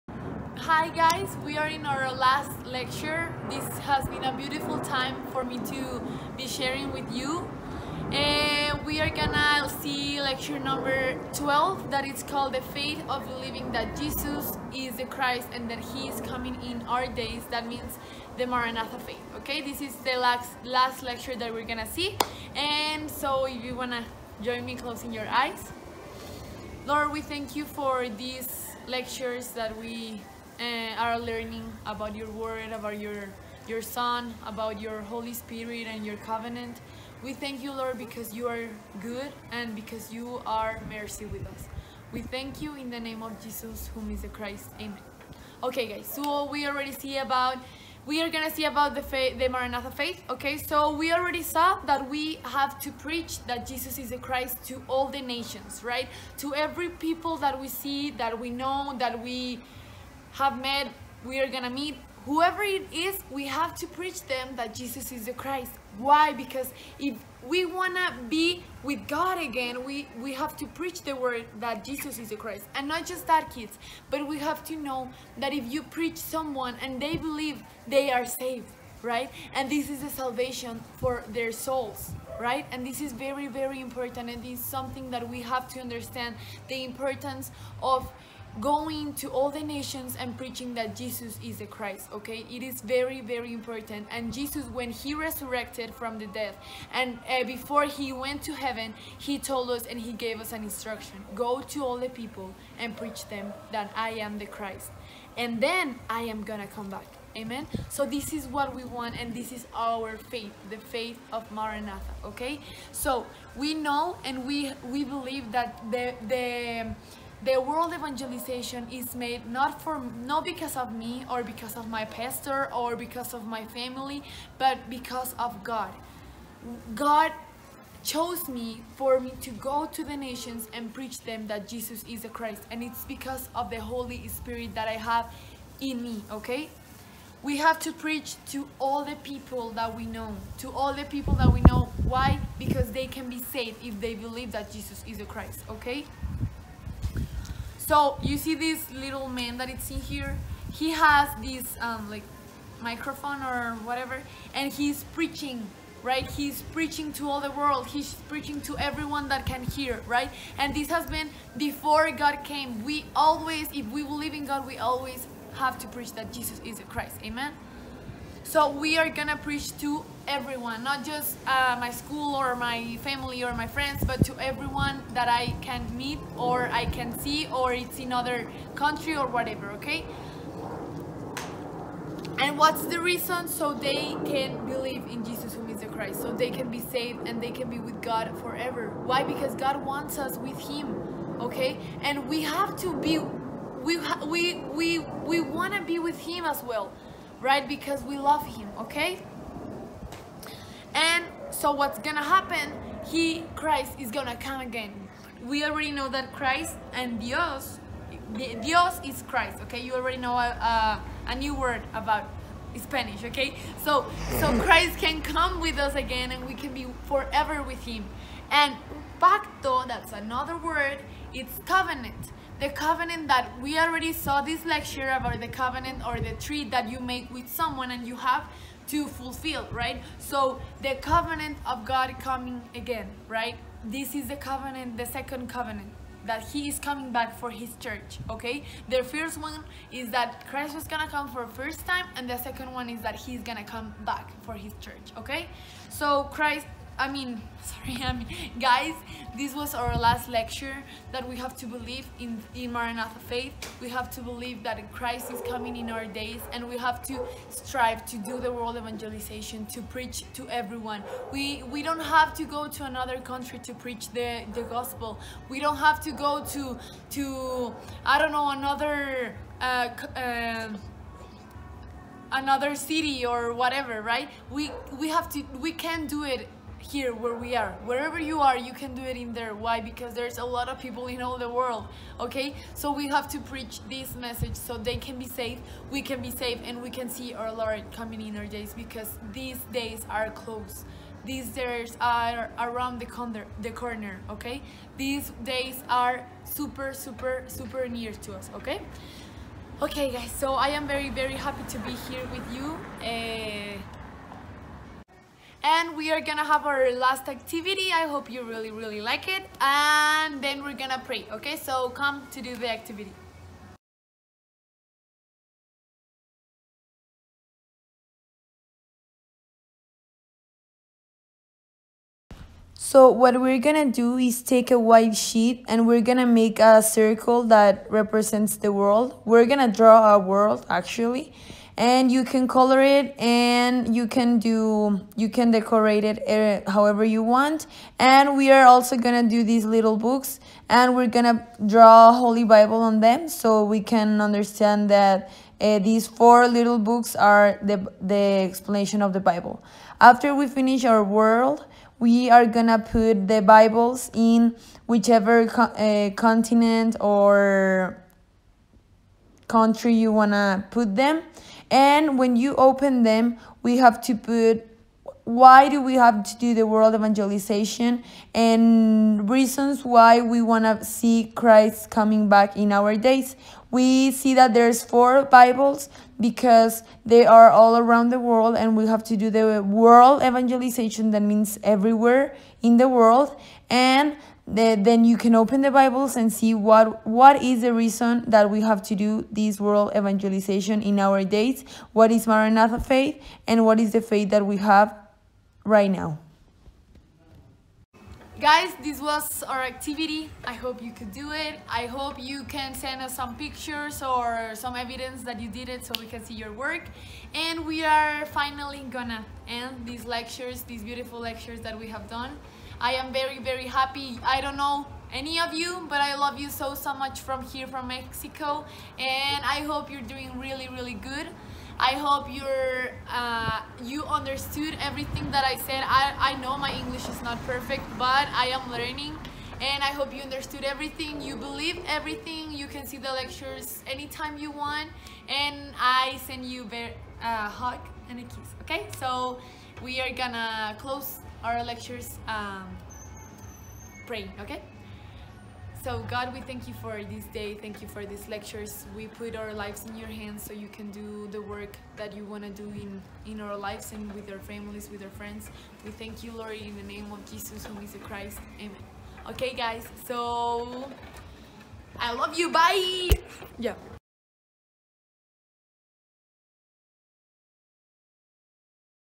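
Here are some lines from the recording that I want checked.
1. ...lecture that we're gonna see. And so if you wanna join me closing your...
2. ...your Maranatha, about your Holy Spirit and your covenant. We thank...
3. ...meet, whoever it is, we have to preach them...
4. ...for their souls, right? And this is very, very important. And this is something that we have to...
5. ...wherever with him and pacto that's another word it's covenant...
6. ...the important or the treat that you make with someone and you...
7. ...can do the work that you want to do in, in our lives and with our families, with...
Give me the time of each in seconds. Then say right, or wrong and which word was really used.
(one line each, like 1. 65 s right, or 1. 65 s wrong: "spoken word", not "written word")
1. 21 s right
2. 33 s wrong: "Son", not "Maranatha"
3. 61 s right
4. 80 s right
5. 217 s wrong: "forever", not "wherever"
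6. 225 s wrong: "covenant", not "important"
7. 450 s right.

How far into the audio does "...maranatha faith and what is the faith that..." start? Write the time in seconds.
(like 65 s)
392 s.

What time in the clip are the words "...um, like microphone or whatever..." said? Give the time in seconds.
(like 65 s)
151 s.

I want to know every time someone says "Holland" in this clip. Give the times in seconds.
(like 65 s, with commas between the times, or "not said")
not said.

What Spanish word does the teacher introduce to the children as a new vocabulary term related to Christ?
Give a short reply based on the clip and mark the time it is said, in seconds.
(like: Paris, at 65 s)
dios, at 207 s.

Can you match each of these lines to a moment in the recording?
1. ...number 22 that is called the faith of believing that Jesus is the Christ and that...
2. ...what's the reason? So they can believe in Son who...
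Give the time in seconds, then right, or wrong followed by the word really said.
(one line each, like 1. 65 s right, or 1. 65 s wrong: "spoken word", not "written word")
1. 10 s wrong: "12", not "22"
2. 182 s wrong: "Jesus", not "Son".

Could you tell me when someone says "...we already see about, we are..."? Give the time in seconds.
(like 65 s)
46 s.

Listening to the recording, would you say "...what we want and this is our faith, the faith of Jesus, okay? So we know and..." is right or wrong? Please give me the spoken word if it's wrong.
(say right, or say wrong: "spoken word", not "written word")
wrong: "Maranatha", not "Jesus".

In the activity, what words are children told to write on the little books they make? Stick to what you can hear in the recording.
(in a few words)
Holy Bible.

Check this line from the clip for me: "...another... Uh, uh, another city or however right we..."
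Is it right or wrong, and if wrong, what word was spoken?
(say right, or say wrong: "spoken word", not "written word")
wrong: "whatever", not "however".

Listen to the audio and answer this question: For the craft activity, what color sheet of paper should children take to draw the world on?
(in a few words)
white.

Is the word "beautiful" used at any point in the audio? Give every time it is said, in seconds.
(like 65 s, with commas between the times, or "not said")
4 s, 410 s.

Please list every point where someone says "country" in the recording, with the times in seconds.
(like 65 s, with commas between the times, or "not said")
178 s, 263 s, 359 s.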